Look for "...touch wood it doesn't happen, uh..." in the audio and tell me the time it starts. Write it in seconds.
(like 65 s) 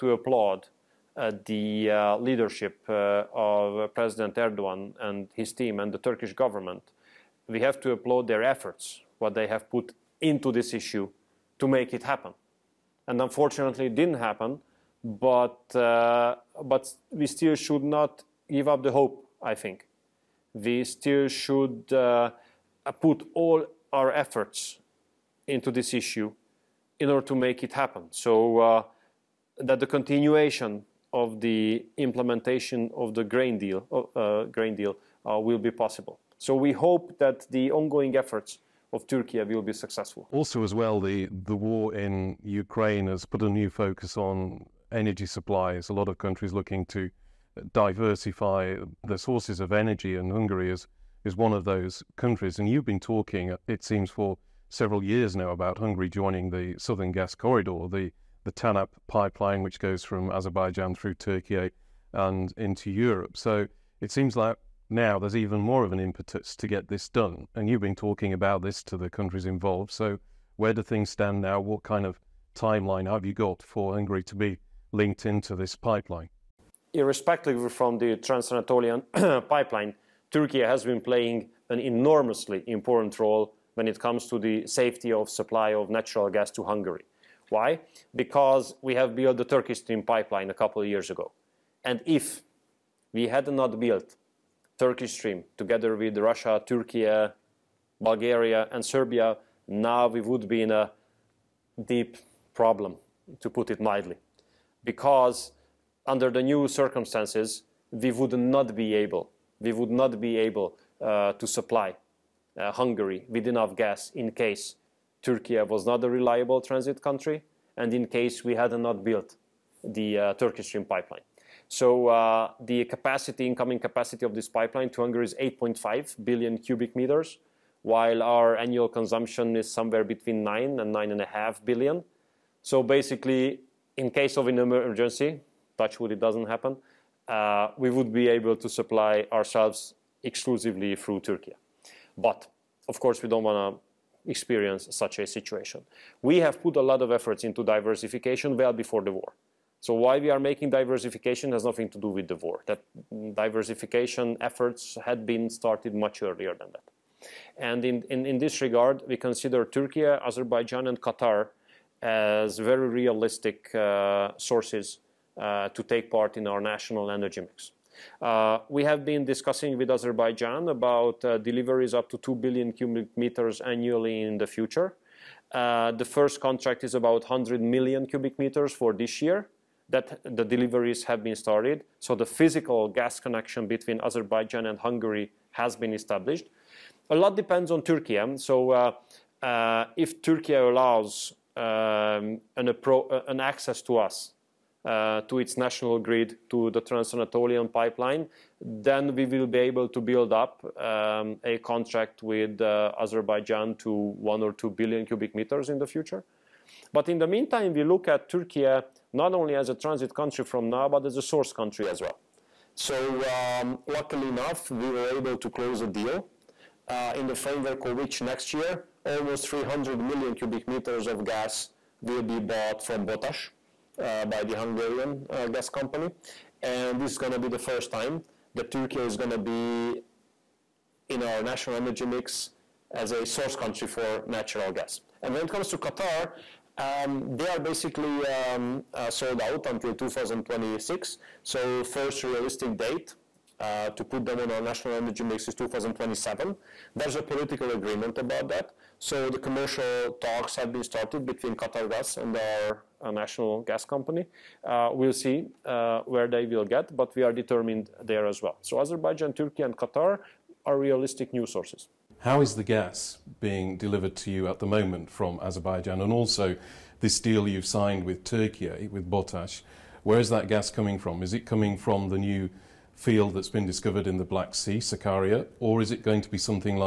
135 s.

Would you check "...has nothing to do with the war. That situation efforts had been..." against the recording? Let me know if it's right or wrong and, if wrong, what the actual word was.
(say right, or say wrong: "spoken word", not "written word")
wrong: "diversification", not "situation".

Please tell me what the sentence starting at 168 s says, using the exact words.
Uh, we have been discussing with Azerbaijan about uh, deliveries up to 2 billion cubic meters annually in the future.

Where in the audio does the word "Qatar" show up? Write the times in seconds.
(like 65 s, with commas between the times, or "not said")
160 s, 235 s, 251 s, 259 s.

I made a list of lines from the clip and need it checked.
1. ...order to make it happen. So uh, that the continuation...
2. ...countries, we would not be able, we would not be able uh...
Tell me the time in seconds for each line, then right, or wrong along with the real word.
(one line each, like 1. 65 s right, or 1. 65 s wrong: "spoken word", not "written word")
1. 27 s right
2. 106 s wrong: "circumstances", not "countries".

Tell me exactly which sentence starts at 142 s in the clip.
But, of course, we don't want to experience such a situation.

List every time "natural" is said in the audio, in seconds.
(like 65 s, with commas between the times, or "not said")
85 s, 234 s.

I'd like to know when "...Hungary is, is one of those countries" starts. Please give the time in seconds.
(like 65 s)
50 s.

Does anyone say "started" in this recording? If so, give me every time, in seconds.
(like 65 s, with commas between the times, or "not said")
155 s, 181 s, 250 s.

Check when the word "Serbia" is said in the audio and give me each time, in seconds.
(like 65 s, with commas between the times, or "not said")
98 s.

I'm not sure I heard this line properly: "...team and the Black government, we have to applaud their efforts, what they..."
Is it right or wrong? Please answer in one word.
wrong.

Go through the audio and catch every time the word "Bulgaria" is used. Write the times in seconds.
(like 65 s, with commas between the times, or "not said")
97 s.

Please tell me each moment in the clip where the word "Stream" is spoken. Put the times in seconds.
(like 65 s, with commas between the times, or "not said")
89 s, 95 s, 120 s.